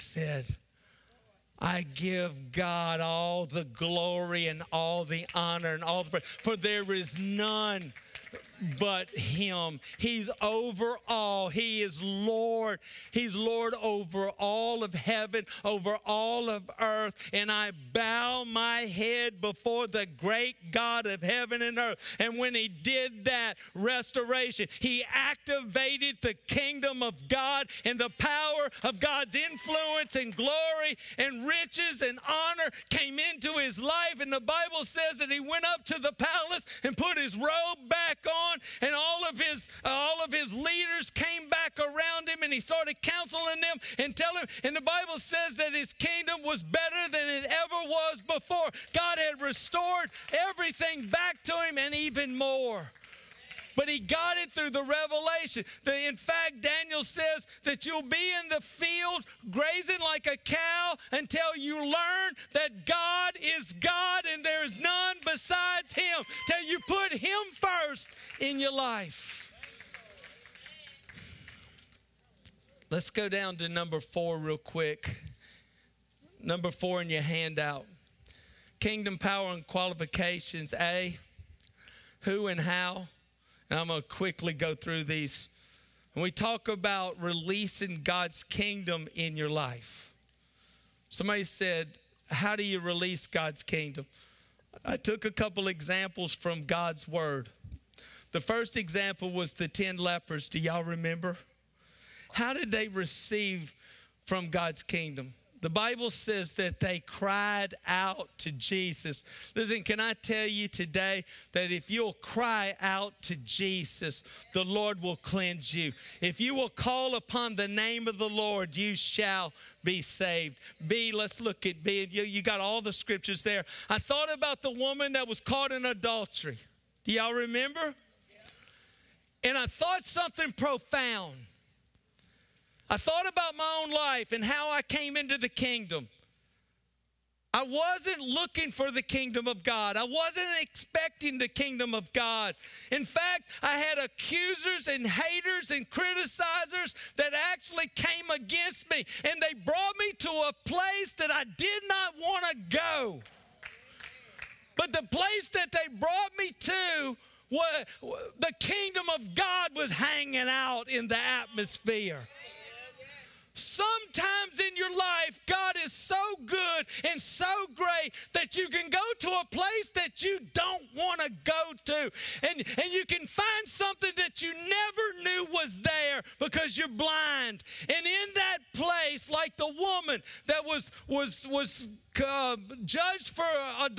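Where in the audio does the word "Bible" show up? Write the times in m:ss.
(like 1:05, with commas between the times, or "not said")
0:34, 0:44, 1:45.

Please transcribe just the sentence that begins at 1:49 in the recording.
Listen, can I tell you today that if you'll cry out to Jesus, the Lord will cleanse you.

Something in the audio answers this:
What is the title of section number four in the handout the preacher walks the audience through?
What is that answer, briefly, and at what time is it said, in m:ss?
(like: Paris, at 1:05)
Kingdom power and qualifications, at 1:18.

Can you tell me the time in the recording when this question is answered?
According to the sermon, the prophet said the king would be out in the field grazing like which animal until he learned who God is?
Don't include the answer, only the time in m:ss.
1:00.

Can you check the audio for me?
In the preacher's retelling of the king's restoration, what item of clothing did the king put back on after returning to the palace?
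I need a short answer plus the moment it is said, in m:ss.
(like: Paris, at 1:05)
His robe, at 0:37.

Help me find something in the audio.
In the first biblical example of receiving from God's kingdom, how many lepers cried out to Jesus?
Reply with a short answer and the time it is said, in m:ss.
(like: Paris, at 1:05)
10, at 1:39.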